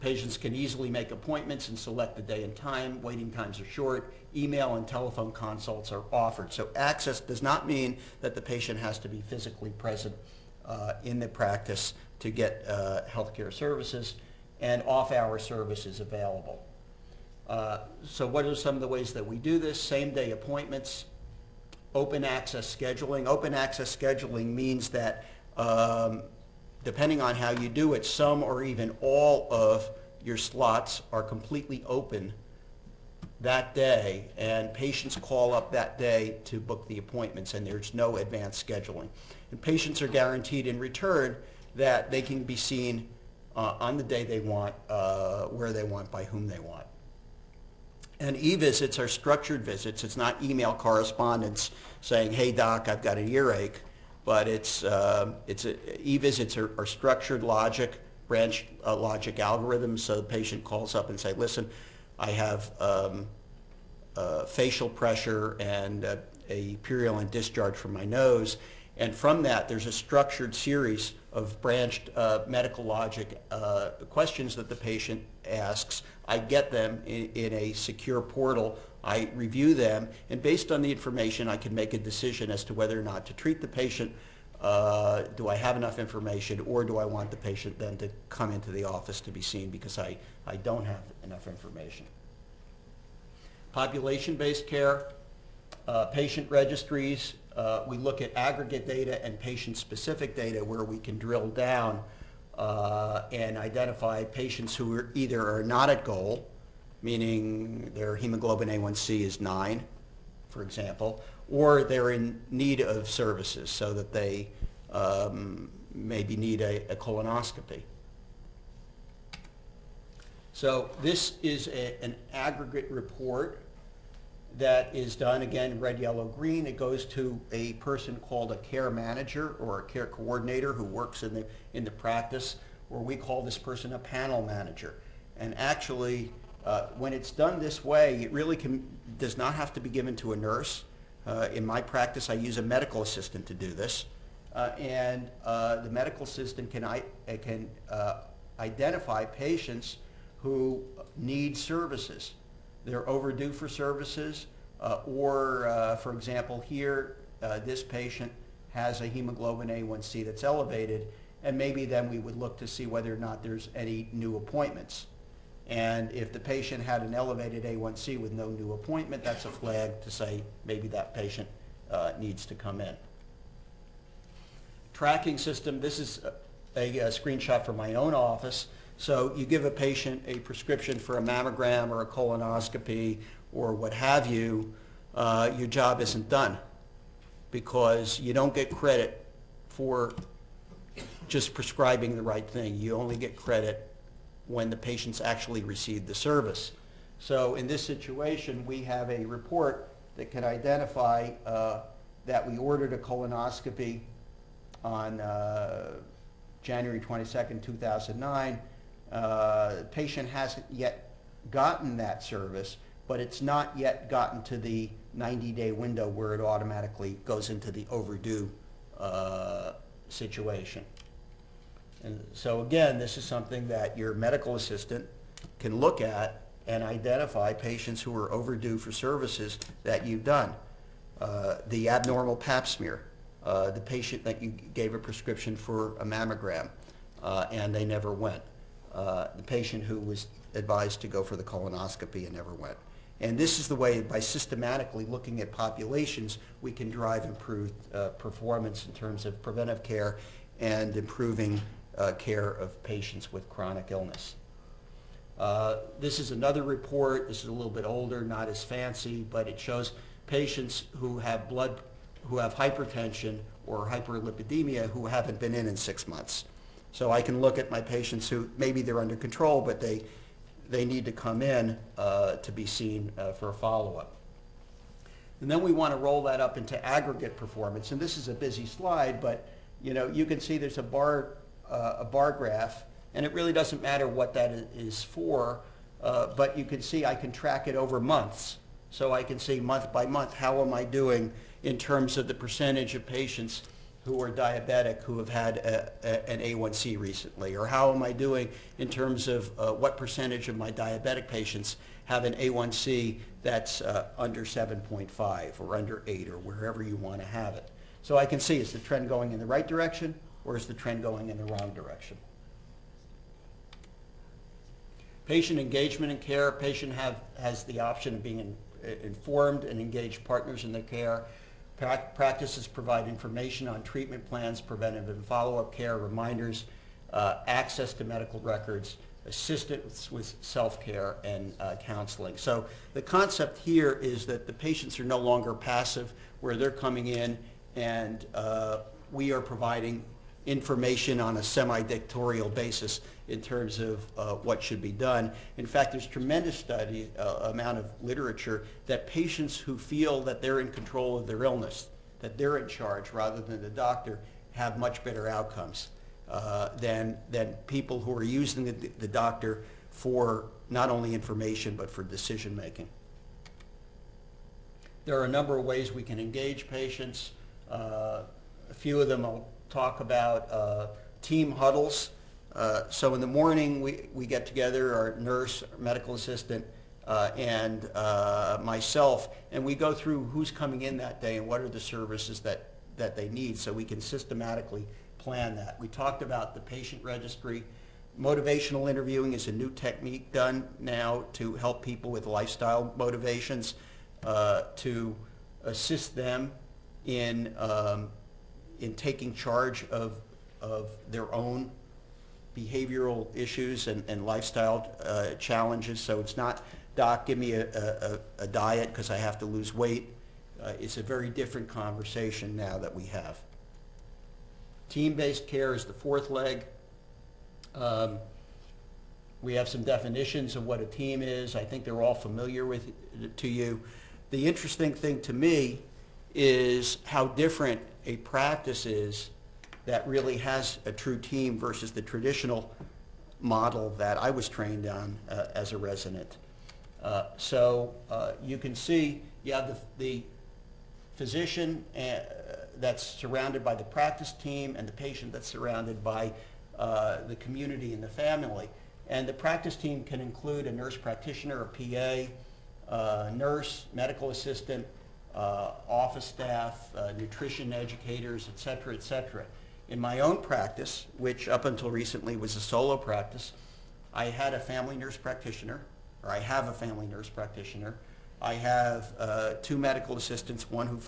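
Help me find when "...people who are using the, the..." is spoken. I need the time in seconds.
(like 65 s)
357 s.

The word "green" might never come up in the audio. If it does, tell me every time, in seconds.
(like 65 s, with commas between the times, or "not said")
126 s.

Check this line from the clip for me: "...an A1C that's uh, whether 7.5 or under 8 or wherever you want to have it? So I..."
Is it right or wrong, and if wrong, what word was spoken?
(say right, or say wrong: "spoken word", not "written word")
wrong: "under", not "whether".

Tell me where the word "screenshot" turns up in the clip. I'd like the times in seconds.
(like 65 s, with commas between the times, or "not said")
177 s.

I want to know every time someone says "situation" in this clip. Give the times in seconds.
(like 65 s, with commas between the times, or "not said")
197 s, 220 s.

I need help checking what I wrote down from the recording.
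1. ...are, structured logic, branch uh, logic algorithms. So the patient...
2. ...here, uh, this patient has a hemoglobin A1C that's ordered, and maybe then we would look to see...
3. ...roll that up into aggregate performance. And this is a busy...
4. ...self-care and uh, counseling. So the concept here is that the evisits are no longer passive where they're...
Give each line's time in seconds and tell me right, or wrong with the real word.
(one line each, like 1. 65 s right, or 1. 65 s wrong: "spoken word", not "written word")
1. 56 s right
2. 156 s wrong: "elevated", not "ordered"
3. 275 s right
4. 330 s wrong: "patients", not "evisits".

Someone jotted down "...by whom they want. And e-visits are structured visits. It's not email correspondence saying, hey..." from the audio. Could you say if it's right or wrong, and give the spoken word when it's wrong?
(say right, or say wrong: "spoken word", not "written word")
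right.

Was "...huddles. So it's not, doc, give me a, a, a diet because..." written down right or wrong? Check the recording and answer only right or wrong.
wrong.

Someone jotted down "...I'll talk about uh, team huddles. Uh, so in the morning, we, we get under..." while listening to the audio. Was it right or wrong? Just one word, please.
wrong.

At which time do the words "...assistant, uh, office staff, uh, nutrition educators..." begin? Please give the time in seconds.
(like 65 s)
454 s.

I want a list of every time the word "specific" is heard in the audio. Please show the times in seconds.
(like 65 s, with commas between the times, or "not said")
99 s.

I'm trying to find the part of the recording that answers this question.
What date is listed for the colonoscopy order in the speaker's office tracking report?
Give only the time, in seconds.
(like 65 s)
206 s.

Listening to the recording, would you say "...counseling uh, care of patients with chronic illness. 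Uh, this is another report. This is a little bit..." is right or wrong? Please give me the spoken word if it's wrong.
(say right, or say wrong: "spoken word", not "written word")
wrong: "improving", not "counseling".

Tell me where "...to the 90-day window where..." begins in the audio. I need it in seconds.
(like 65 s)
214 s.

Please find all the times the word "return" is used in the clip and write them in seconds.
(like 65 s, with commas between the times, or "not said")
40 s.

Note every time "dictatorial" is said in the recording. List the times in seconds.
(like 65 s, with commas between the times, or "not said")
341 s.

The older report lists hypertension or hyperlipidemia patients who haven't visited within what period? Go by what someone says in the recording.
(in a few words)
six months.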